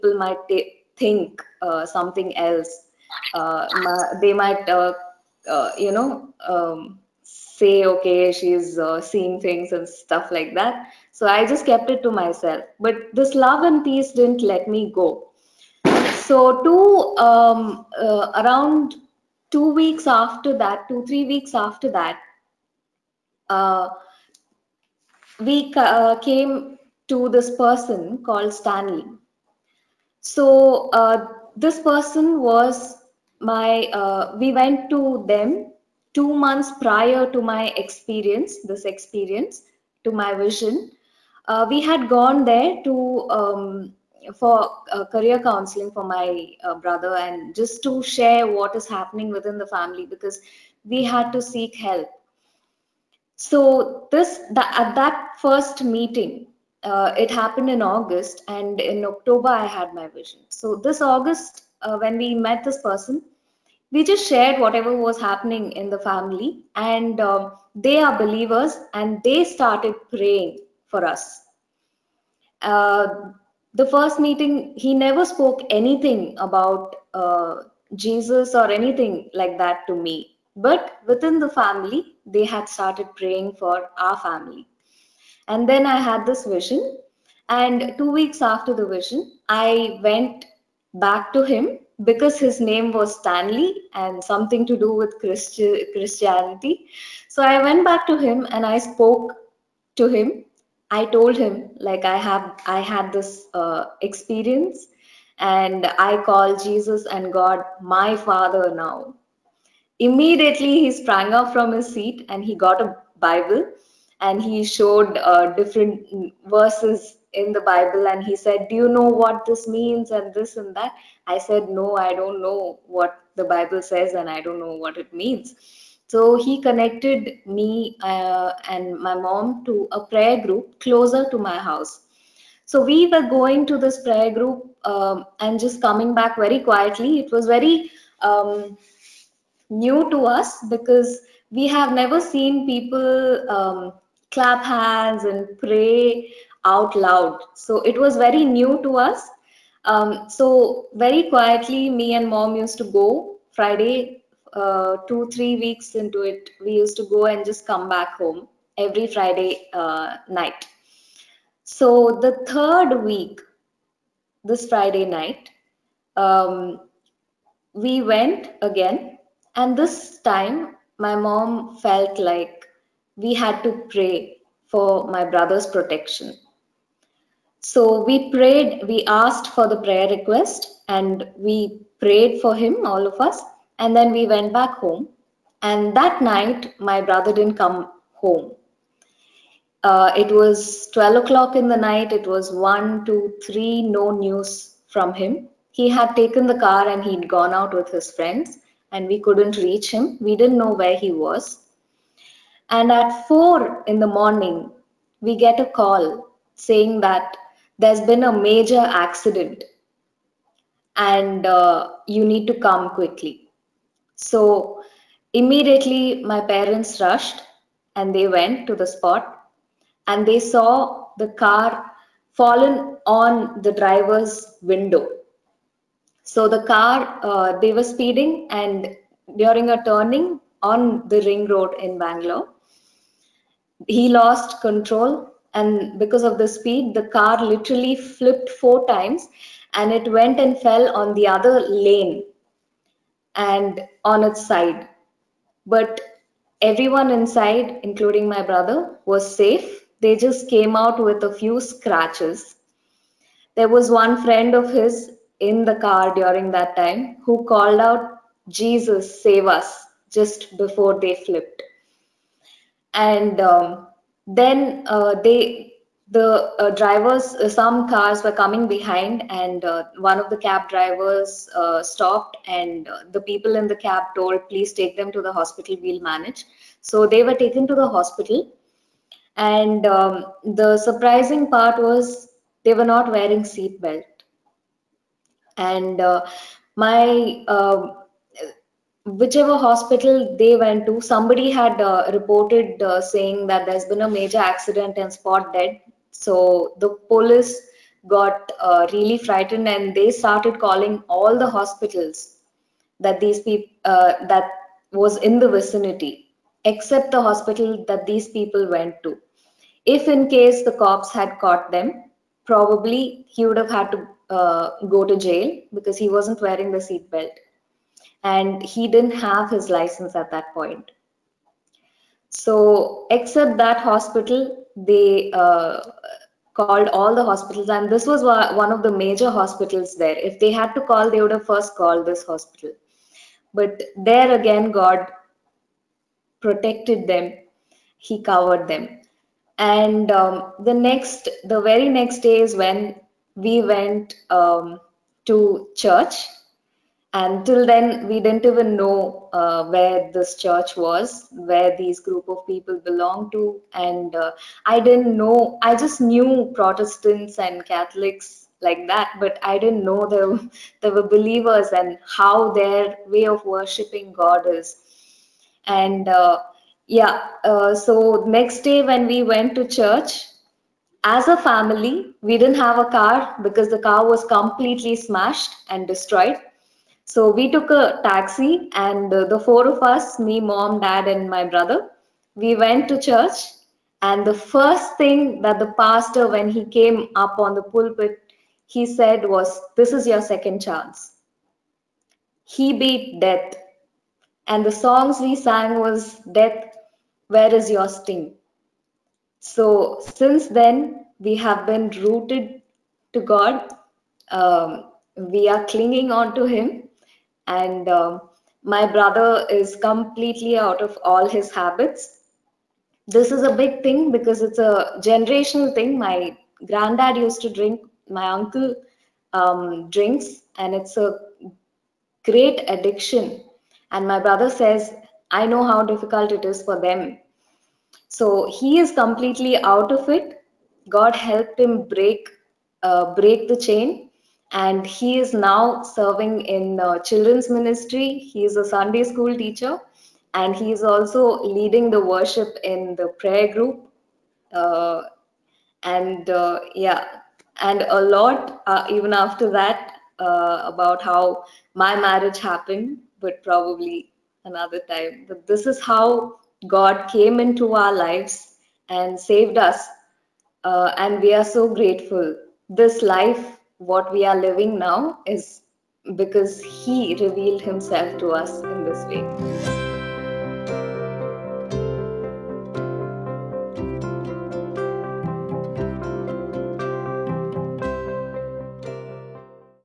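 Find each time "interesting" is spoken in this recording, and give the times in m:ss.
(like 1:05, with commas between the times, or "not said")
not said.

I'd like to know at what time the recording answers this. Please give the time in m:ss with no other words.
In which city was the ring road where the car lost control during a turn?
3:51.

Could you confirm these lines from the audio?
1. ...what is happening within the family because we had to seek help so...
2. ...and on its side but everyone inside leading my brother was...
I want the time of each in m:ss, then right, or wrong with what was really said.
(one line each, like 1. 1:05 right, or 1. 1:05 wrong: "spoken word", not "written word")
1. 0:48 right
2. 4:03 wrong: "including", not "leading".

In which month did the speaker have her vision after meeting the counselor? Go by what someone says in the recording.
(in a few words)
October.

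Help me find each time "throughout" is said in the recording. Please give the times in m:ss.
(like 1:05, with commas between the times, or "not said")
not said.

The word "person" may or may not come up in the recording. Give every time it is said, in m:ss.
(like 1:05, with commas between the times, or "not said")
0:27, 0:31, 1:02.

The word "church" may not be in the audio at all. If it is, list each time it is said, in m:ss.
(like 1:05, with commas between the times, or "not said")
5:45, 5:50, 6:09, 6:22.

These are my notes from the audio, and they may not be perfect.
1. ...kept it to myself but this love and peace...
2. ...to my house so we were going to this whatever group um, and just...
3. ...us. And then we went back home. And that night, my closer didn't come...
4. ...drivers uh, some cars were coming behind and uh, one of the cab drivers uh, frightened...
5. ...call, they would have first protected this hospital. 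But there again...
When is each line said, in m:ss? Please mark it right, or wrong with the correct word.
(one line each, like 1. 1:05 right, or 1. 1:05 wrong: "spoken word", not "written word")
1. 0:11 right
2. 2:11 wrong: "prayer", not "whatever"
3. 3:03 wrong: "brother", not "closer"
4. 4:26 wrong: "stopped", not "frightened"
5. 5:30 wrong: "called", not "protected".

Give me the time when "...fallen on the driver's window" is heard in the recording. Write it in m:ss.
3:42.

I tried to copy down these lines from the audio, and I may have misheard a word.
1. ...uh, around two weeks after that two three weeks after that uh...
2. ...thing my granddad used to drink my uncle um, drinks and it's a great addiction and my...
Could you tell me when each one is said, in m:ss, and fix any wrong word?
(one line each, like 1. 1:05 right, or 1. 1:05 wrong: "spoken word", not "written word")
1. 0:17 right
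2. 6:55 right.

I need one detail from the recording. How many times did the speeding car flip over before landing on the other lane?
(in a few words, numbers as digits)
4.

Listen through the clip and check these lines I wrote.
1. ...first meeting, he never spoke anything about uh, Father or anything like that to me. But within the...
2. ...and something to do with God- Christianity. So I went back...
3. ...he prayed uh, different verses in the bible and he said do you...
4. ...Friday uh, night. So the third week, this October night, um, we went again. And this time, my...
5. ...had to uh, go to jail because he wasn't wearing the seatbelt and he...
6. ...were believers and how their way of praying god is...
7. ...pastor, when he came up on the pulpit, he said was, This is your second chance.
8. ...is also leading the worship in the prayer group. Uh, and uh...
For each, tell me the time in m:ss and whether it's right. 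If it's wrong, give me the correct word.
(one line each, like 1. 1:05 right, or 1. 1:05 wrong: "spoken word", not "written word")
1. 1:13 wrong: "Jesus", not "Father"
2. 1:33 wrong: "Christi", not "God"
3. 1:54 wrong: "showed", not "prayed"
4. 2:39 wrong: "Friday", not "October"
5. 5:13 right
6. 6:00 wrong: "worshiping", not "praying"
7. 6:25 right
8. 7:20 right.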